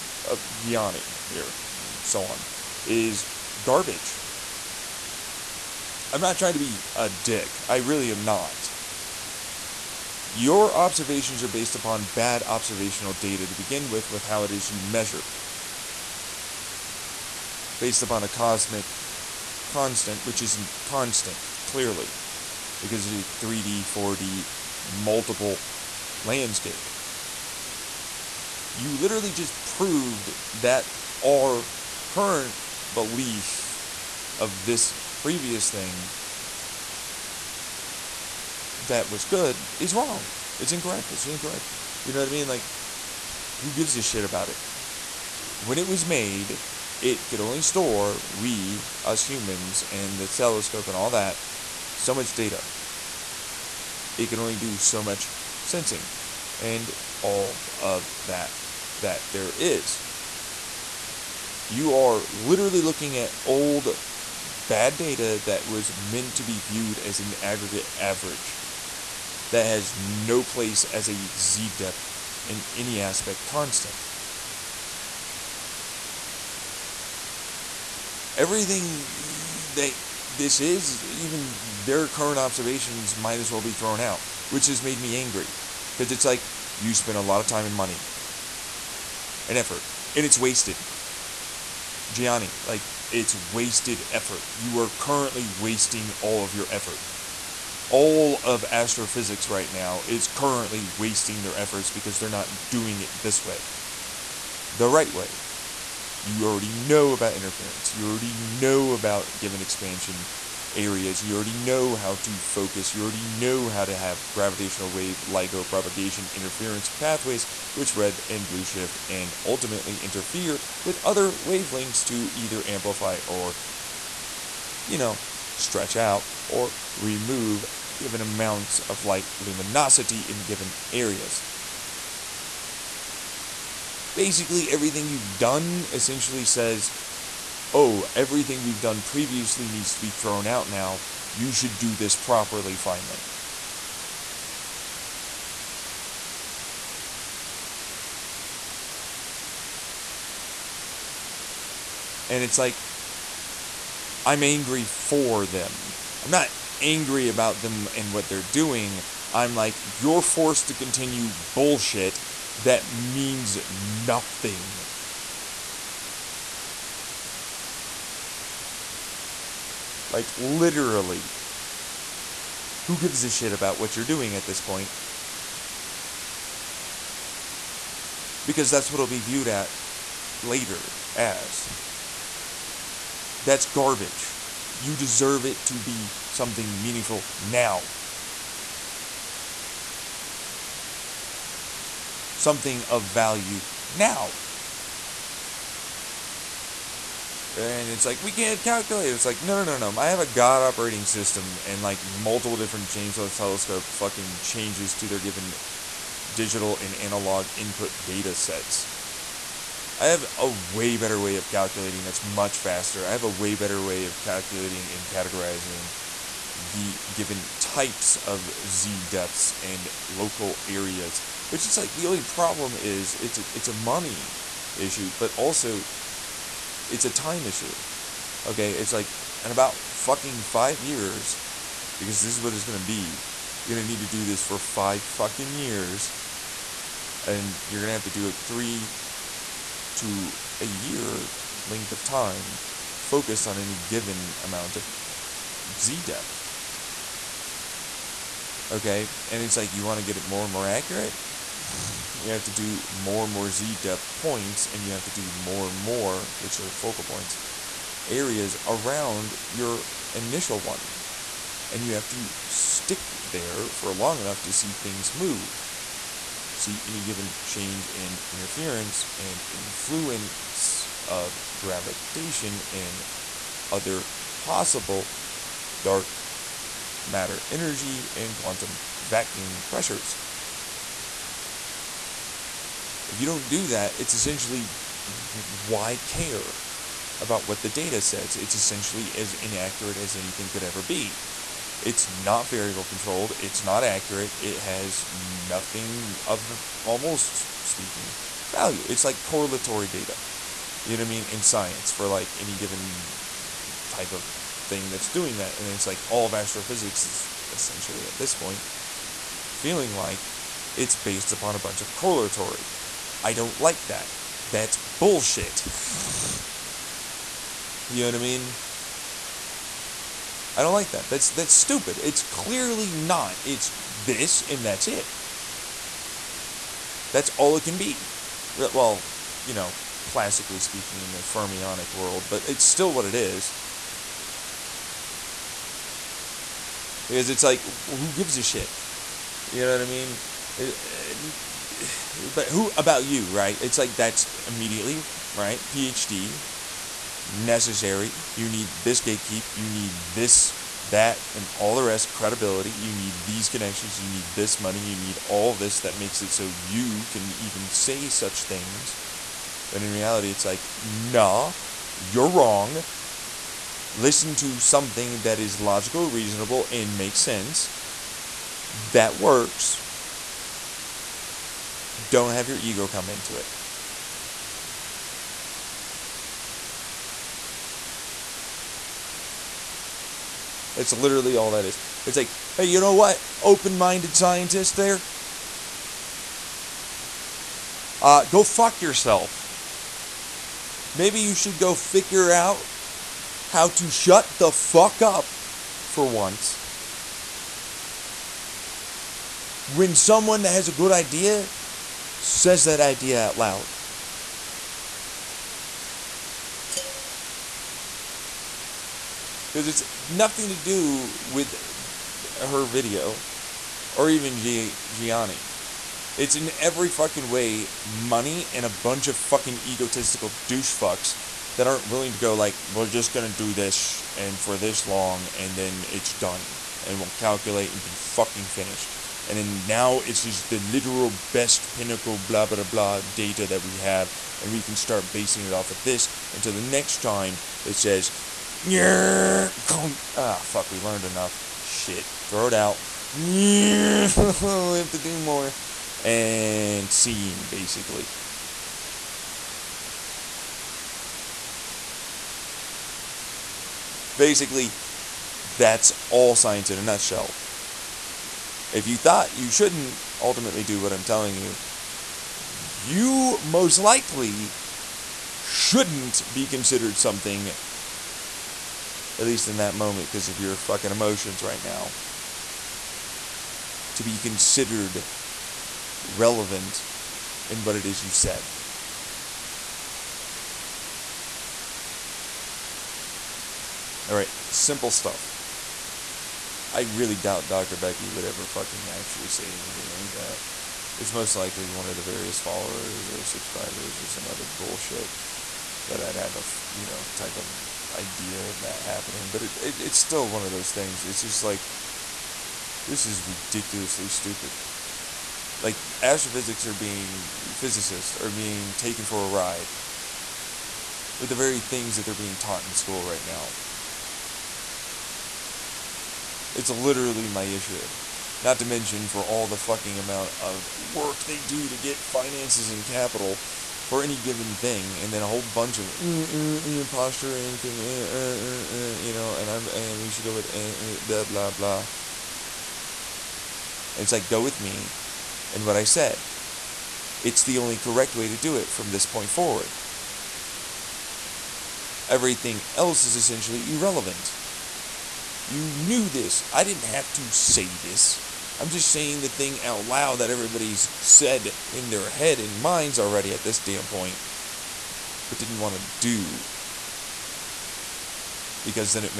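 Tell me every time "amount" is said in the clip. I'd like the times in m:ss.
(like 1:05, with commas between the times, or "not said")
2:08, 4:04, 8:39.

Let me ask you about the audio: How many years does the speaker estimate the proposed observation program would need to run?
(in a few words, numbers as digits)
5 years.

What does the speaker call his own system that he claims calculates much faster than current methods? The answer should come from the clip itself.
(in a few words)
God operating system.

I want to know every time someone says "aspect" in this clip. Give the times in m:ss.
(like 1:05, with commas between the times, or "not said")
1:13.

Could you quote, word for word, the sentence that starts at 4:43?
If you don't do that, it's essentially why care about what the data says?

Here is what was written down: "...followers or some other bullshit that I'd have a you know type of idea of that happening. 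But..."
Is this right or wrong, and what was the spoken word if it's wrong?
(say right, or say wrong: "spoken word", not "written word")
wrong: "subscribers", not "followers".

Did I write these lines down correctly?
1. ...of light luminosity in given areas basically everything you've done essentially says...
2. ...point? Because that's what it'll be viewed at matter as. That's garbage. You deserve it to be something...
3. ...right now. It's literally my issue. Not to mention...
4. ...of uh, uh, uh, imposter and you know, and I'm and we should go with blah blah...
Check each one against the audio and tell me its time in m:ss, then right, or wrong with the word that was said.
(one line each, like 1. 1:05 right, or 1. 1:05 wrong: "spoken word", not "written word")
1. 2:08 right
2. 2:54 wrong: "later", not "matter"
3. 8:33 right
4. 8:45 right.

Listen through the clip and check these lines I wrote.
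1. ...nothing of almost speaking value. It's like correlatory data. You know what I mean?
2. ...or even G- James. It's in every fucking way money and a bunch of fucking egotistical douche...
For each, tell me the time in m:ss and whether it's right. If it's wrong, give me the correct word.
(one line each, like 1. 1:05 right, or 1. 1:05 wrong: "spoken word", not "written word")
1. 4:55 right
2. 6:53 wrong: "Gianni", not "James".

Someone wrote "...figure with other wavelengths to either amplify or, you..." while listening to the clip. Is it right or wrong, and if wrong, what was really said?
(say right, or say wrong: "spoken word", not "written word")
wrong: "interfere", not "figure".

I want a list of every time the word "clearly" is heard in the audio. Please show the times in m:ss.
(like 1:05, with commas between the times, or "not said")
0:21, 5:22.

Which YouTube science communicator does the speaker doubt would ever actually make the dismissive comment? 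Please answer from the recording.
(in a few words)
Dr. Becky.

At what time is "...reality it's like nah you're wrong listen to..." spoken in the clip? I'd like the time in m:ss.
5:59.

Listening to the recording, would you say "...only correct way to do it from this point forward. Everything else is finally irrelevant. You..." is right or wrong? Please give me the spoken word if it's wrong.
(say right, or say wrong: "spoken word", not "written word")
wrong: "essentially", not "finally".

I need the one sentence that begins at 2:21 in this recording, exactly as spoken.
You should do this properly finally.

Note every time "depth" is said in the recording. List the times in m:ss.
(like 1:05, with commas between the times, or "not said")
1:11, 3:39, 4:06, 4:13.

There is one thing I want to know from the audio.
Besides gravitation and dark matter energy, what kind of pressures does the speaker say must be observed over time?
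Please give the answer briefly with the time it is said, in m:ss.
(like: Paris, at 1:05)
quantum vacuum pressures, at 4:38.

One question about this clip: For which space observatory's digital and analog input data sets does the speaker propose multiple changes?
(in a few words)
James Webb telescope.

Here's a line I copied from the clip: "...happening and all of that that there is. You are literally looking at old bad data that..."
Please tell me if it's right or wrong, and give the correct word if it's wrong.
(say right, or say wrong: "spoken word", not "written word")
wrong: "sensing", not "happening".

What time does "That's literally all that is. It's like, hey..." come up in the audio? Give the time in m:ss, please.
6:20.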